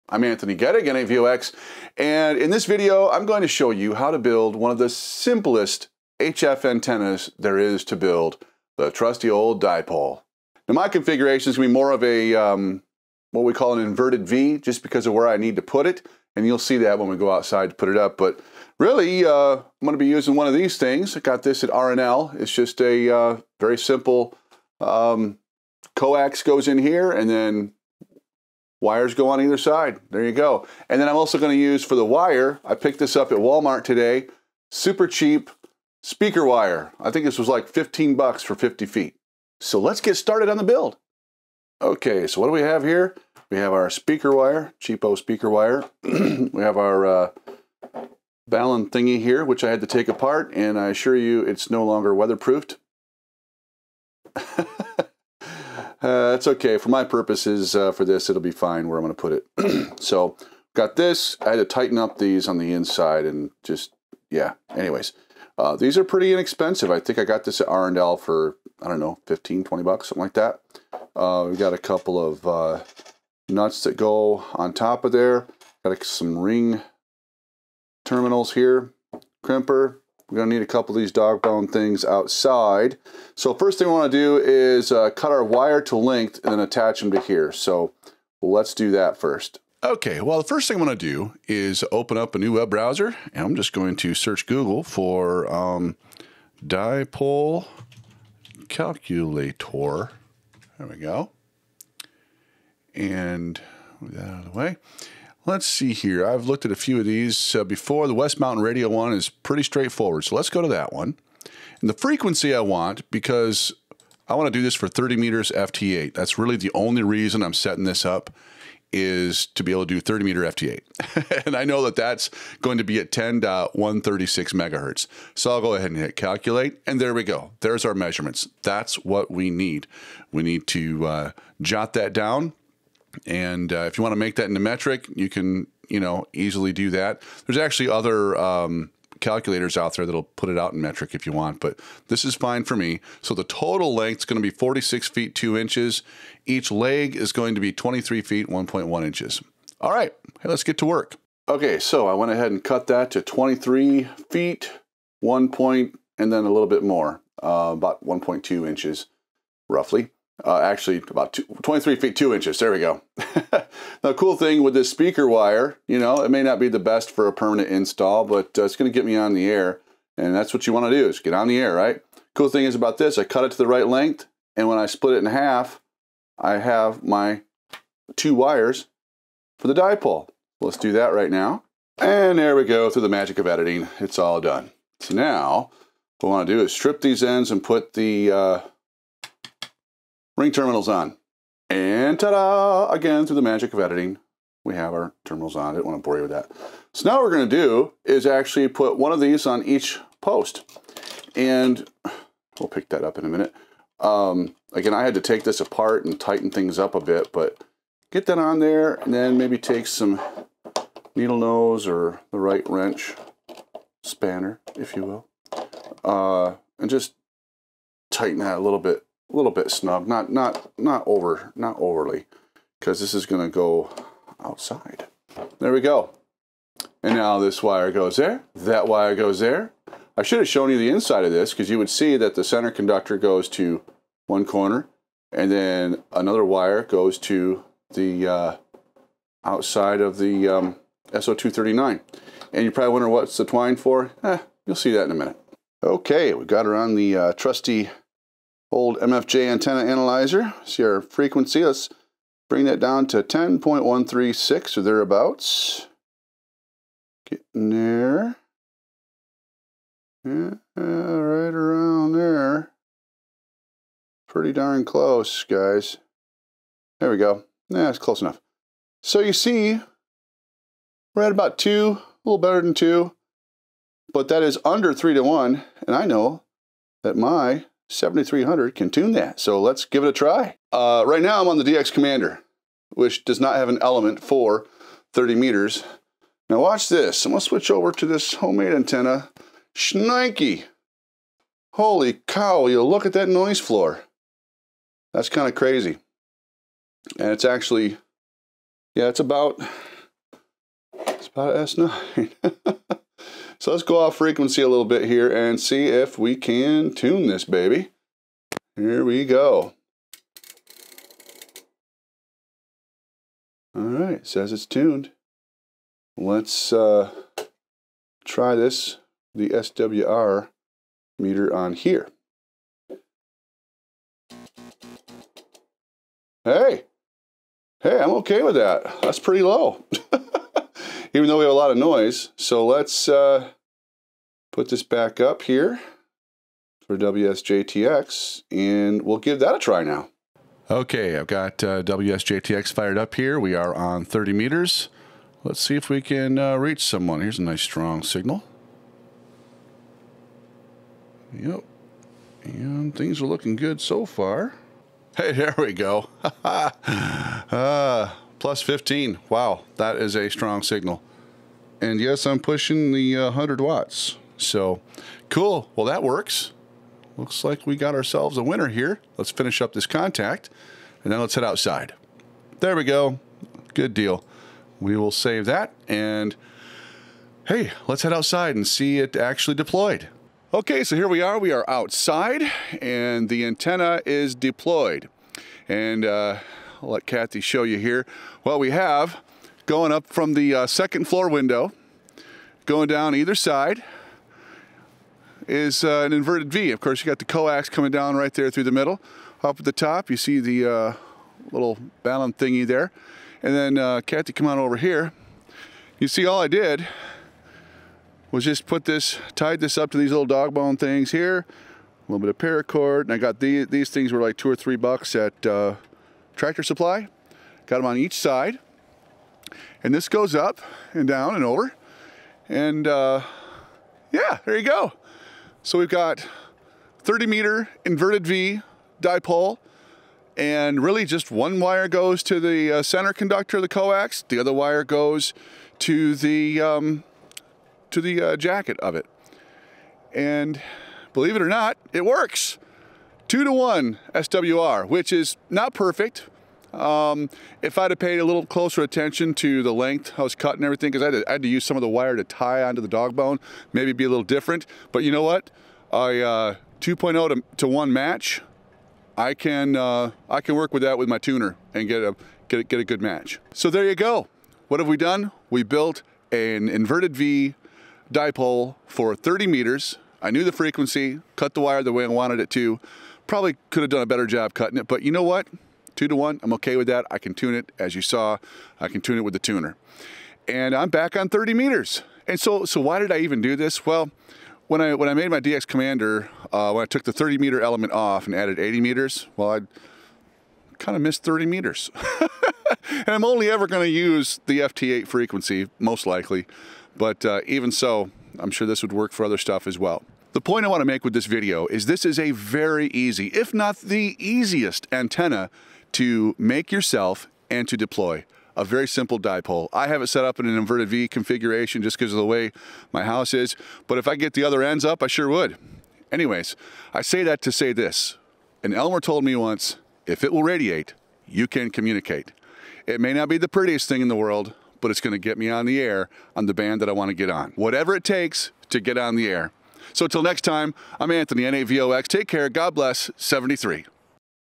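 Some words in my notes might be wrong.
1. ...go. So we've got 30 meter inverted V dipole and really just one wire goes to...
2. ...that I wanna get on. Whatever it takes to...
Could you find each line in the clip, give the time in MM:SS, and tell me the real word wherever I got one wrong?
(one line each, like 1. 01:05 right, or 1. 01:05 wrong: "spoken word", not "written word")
1. 07:04 right
2. 08:46 right.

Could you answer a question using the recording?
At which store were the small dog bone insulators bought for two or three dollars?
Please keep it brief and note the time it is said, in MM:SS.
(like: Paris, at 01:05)
Tractor Supply, at 06:56.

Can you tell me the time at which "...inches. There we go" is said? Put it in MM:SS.
02:42.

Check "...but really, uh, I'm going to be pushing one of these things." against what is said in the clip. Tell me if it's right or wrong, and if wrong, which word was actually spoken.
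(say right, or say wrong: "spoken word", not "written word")
wrong: "using", not "pushing".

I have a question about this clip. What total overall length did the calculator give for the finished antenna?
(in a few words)
46 feet 2 inches.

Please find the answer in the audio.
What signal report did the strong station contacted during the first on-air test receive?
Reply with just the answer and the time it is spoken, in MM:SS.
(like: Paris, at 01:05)
+15, at 05:58.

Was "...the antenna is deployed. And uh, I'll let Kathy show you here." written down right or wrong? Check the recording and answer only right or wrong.
right.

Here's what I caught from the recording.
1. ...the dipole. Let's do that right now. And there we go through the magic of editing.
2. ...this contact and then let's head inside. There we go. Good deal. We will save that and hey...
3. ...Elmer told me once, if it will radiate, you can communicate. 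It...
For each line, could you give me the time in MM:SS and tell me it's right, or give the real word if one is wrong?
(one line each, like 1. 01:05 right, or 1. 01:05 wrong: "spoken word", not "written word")
1. 02:59 right
2. 06:09 wrong: "outside", not "inside"
3. 08:38 right.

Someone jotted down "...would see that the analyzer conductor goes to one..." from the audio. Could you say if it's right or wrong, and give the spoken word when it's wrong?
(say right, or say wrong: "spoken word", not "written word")
wrong: "center", not "analyzer".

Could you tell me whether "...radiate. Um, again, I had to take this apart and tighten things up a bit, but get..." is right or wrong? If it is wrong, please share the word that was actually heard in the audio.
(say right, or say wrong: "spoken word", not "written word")
wrong: "minute", not "radiate".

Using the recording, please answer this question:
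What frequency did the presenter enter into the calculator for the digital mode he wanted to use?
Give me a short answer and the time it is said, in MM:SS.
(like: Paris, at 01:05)
10.136 MHz, at 02:03.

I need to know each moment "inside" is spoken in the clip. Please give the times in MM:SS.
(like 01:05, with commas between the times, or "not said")
01:02, 03:50.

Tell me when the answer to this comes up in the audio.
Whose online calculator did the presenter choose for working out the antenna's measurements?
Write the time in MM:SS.
01:48.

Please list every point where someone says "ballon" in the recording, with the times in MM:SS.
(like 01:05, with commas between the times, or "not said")
00:48.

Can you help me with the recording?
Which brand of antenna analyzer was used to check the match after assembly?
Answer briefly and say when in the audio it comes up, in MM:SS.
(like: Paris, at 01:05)
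MFJ, at 04:08.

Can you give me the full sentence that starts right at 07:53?
Probably could have done a better job cutting it, but you know what?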